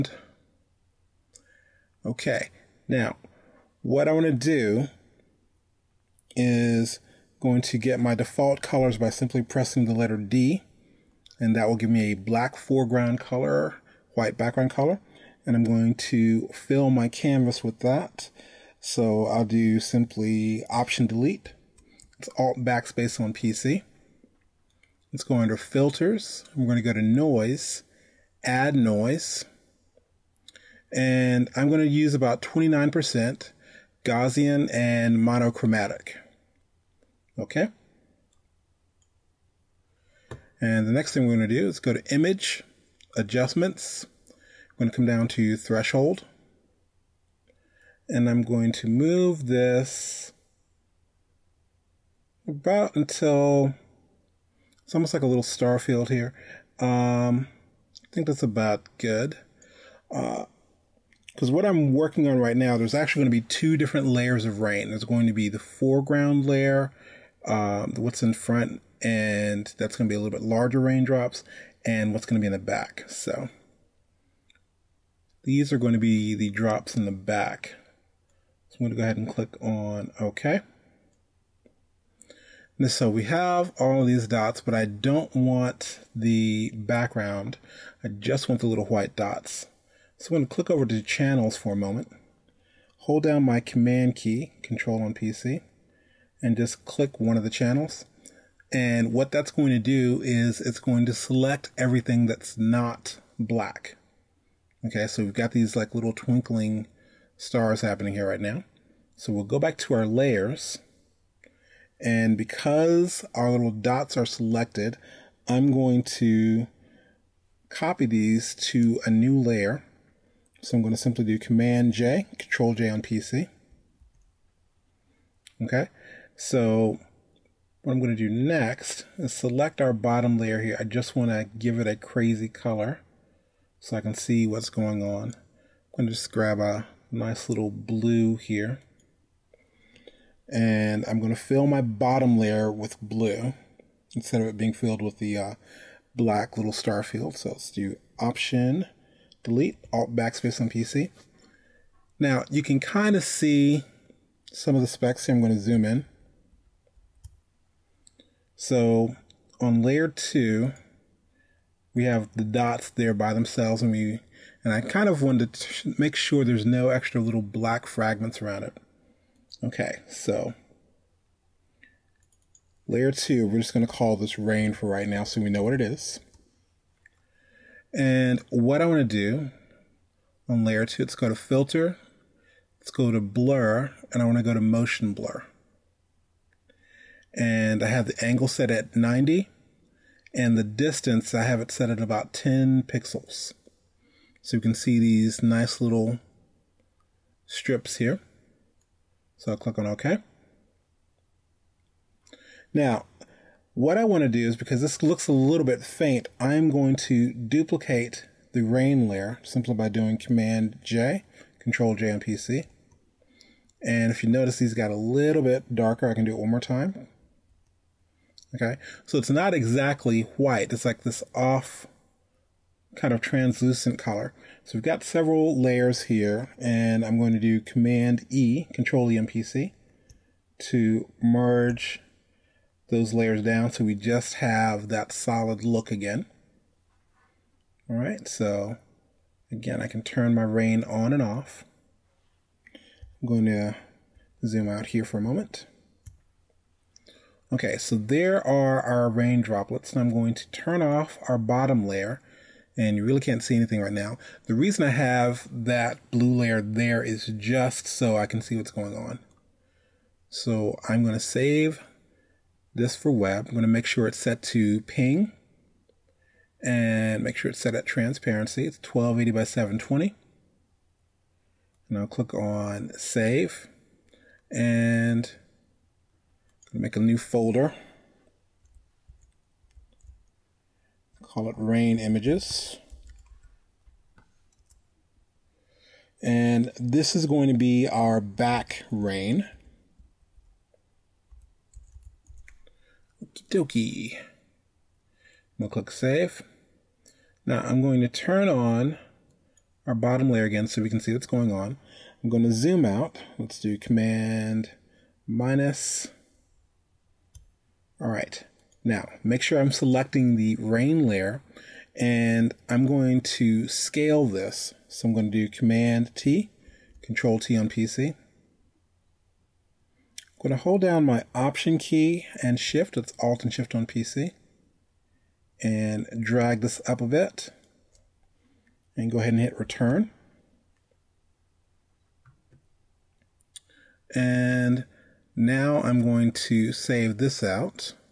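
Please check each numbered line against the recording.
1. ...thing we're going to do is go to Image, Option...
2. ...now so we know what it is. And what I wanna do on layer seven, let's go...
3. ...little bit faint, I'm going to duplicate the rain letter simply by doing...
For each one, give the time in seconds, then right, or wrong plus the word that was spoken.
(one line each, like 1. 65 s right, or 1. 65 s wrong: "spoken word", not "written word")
1. 41 s wrong: "Adjustments", not "Option"
2. 175 s wrong: "two", not "seven"
3. 205 s wrong: "layer", not "letter".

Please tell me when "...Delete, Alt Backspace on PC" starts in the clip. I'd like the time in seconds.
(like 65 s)
149 s.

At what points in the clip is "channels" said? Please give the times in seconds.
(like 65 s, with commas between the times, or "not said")
91 s, 97 s.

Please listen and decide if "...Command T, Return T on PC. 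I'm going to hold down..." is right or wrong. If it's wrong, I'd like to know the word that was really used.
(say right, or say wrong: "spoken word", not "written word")
wrong: "Control", not "Return".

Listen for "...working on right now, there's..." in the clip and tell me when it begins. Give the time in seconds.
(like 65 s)
61 s.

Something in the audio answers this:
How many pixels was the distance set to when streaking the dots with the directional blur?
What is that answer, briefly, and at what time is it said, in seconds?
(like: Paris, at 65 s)
10 pixels, at 192 s.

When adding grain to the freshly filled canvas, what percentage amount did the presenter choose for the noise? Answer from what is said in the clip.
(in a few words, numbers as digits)
29%.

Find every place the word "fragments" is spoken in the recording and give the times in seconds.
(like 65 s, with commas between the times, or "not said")
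167 s.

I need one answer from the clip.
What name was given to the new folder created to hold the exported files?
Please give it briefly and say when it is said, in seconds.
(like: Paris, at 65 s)
rain images, at 281 s.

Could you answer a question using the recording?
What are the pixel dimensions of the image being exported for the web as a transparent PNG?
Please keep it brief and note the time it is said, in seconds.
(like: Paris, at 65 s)
1280 by 720, at 268 s.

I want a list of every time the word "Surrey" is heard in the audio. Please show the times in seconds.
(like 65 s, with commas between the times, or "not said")
not said.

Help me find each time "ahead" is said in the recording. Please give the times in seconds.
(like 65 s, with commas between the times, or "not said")
79 s, 329 s.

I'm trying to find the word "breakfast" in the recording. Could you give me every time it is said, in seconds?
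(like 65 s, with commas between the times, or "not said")
not said.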